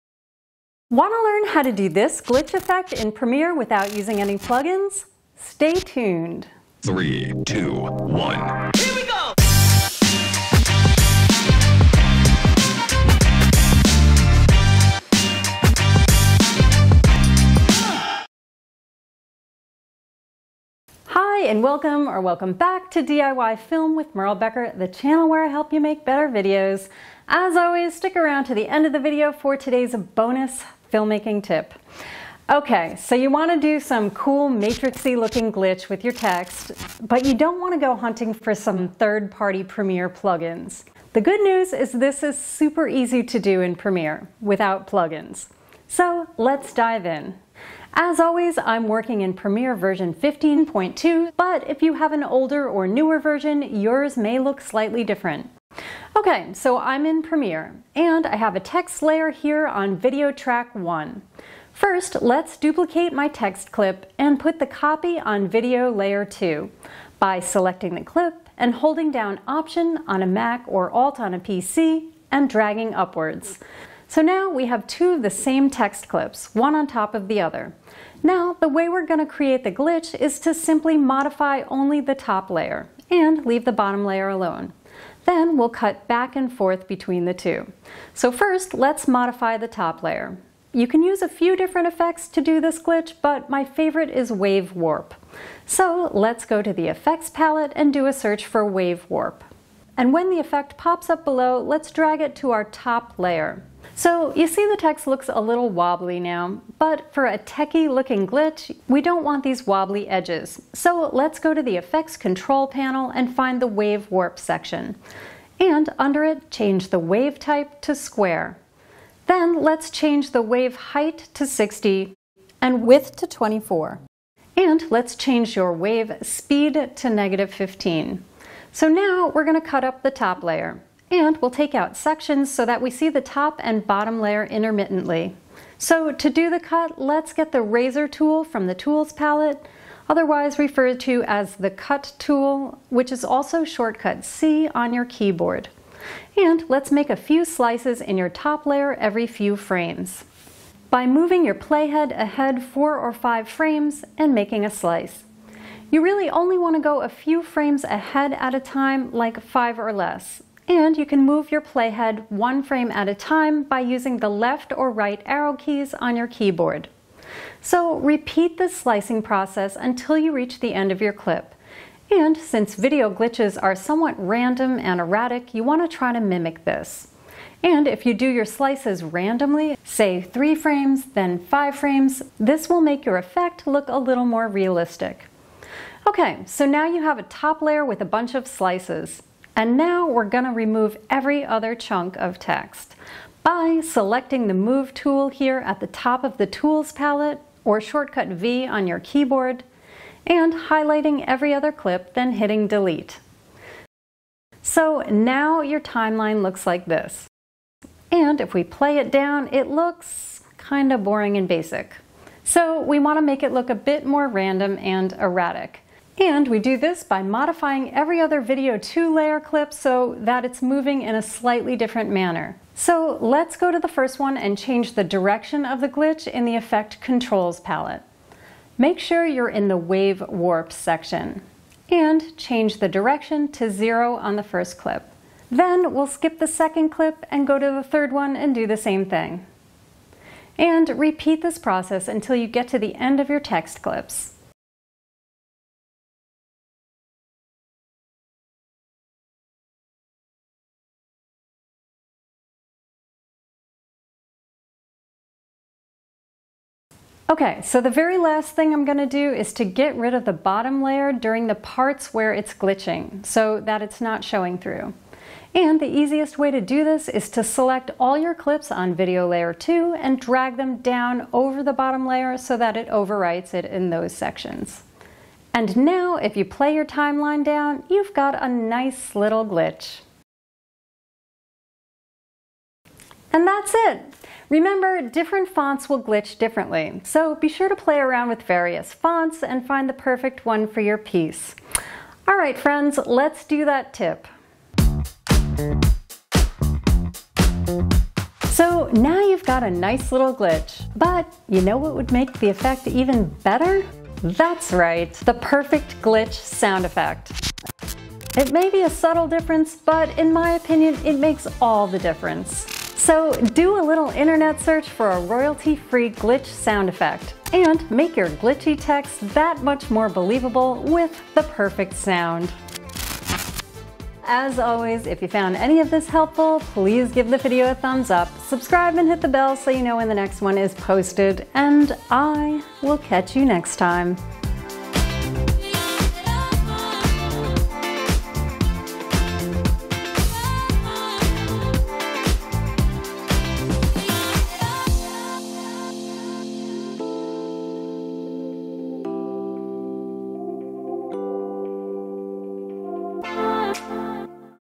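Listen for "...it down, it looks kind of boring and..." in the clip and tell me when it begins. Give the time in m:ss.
3:28.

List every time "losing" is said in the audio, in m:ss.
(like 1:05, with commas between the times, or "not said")
not said.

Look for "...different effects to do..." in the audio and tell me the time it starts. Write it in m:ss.
1:31.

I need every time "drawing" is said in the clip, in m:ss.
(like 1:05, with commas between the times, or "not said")
not said.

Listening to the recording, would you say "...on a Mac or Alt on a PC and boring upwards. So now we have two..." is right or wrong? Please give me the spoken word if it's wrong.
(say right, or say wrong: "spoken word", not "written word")
wrong: "dragging", not "boring".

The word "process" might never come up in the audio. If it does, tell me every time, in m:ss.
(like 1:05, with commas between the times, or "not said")
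2:49, 4:01.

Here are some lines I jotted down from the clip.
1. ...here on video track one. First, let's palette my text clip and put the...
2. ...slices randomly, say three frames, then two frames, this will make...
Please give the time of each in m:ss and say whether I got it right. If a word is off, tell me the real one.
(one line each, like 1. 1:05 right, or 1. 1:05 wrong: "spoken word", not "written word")
1. 0:59 wrong: "duplicate", not "palette"
2. 2:58 wrong: "five", not "two".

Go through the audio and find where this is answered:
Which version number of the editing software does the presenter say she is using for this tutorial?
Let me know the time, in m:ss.
0:50.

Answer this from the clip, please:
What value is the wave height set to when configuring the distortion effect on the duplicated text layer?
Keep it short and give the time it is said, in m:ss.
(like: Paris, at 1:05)
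60, at 2:01.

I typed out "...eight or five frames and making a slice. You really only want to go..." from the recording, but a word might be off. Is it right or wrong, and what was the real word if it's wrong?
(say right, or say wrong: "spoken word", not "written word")
wrong: "four", not "eight".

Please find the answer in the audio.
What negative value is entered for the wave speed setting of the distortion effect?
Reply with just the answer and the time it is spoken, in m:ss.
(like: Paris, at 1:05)
-15, at 2:07.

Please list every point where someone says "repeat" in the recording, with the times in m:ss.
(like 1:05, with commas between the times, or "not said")
2:47, 4:00.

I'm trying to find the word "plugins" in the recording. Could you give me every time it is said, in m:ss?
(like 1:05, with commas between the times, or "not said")
0:04, 0:40, 0:44.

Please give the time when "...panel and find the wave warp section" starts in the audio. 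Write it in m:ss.
1:52.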